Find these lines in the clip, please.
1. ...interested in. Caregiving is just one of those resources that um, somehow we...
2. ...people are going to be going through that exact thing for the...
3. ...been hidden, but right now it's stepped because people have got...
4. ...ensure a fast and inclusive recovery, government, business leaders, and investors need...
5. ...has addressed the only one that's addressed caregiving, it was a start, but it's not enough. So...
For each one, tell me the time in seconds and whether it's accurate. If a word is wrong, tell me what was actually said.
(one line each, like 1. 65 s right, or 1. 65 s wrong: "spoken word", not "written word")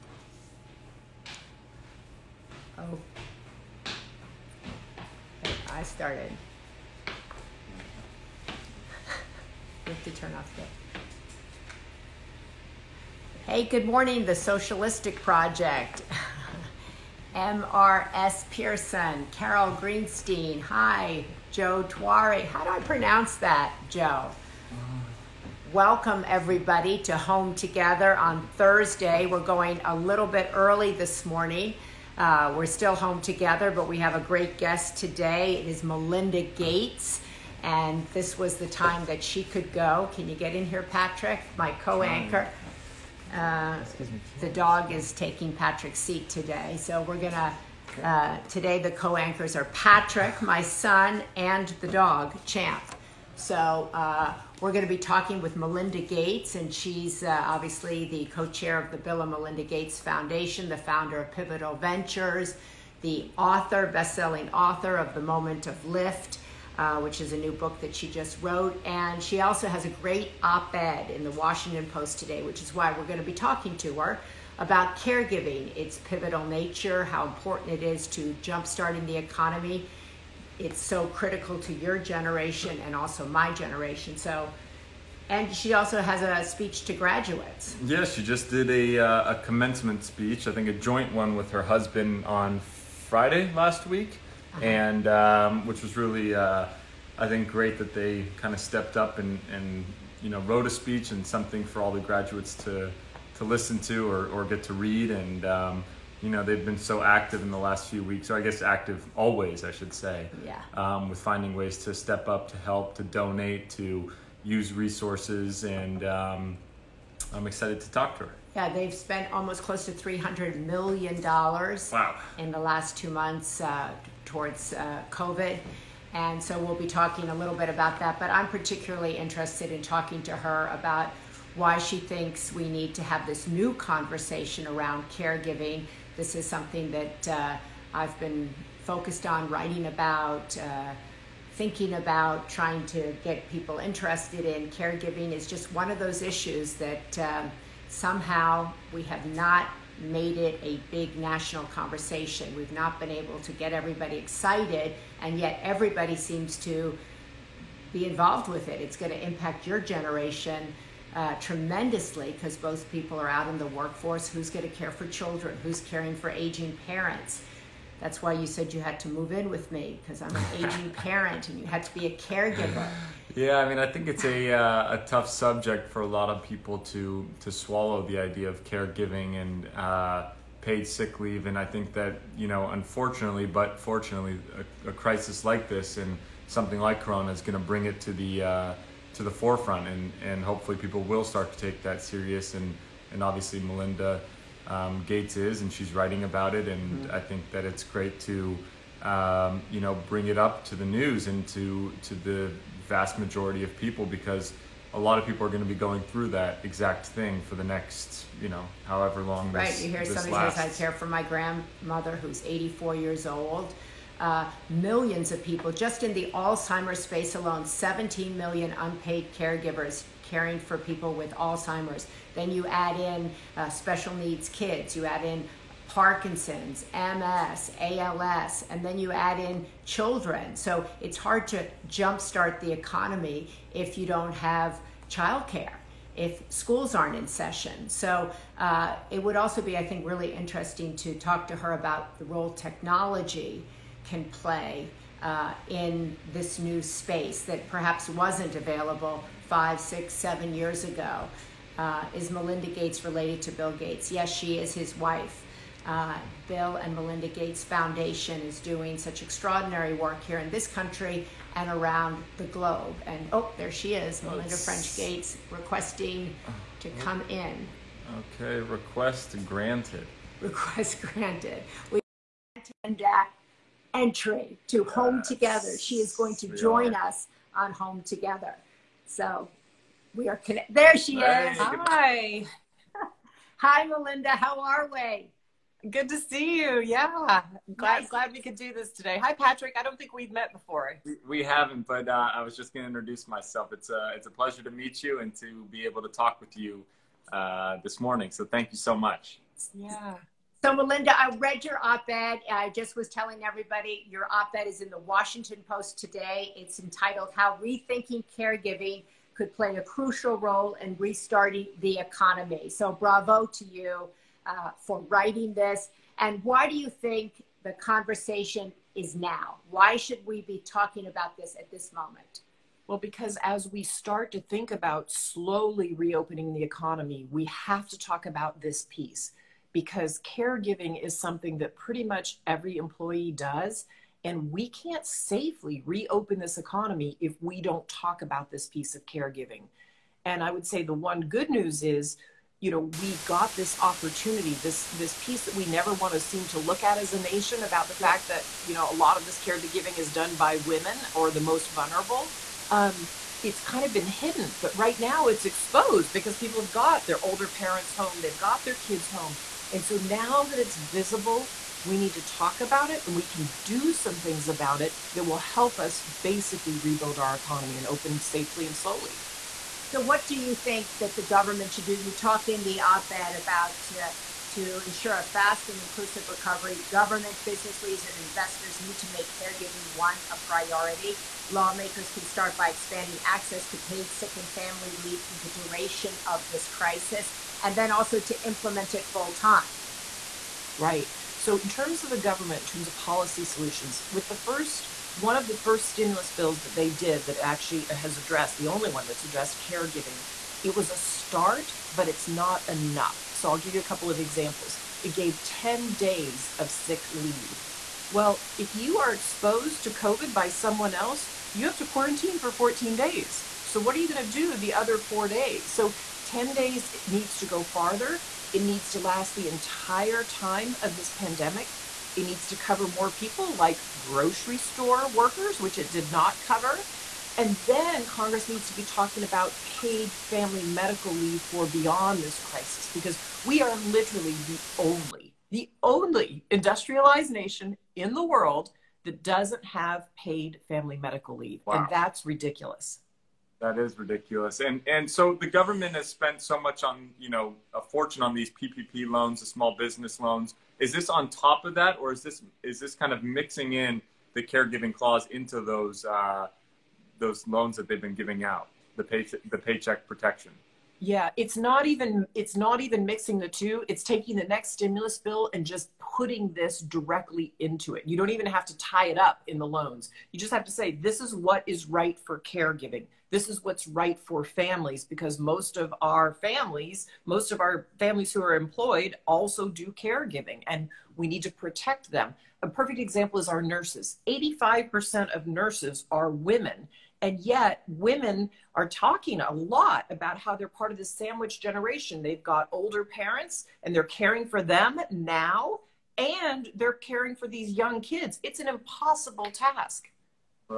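1. 143 s wrong: "issues", not "resources"
2. 205 s right
3. 353 s wrong: "exposed", not "stepped"
4. 374 s right
5. 397 s right.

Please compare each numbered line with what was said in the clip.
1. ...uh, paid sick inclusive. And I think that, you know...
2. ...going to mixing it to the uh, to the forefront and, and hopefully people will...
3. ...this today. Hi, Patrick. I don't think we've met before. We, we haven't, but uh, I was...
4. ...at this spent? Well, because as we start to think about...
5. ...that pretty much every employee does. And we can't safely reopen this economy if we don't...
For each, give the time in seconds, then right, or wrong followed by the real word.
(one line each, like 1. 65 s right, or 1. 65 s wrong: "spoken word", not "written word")
1. 179 s wrong: "leave", not "inclusive"
2. 187 s wrong: "bring", not "mixing"
3. 288 s right
4. 321 s wrong: "moment", not "spent"
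5. 331 s right.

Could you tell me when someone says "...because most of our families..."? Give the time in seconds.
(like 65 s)
475 s.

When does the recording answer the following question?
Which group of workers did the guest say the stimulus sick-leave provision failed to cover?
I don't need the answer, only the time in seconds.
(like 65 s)
423 s.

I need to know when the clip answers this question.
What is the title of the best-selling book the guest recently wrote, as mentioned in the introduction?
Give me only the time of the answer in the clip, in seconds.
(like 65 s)
65 s.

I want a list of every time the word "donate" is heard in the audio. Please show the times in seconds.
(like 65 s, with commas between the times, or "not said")
113 s.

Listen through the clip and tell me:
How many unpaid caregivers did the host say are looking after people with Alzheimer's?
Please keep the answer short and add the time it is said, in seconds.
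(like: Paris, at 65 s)
17 million, at 217 s.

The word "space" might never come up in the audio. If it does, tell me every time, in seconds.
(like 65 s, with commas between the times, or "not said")
217 s, 246 s.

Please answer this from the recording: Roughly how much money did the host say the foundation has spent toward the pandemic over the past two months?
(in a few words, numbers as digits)
300 million dollars.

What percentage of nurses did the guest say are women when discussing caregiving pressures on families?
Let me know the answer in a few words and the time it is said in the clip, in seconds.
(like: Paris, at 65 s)
85%, at 484 s.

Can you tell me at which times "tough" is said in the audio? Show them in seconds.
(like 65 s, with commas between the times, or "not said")
175 s.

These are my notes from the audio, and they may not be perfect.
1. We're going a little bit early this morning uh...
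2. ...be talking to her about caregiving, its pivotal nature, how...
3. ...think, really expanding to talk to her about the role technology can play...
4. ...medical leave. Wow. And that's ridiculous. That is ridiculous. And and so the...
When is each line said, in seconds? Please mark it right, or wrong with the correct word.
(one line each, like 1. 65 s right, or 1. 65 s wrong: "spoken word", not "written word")
1. 29 s right
2. 73 s right
3. 239 s wrong: "interesting", not "expanding"
4. 440 s right.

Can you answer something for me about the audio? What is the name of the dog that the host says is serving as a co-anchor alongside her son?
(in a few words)
Champ.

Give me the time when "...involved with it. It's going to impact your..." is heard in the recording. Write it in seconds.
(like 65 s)
158 s.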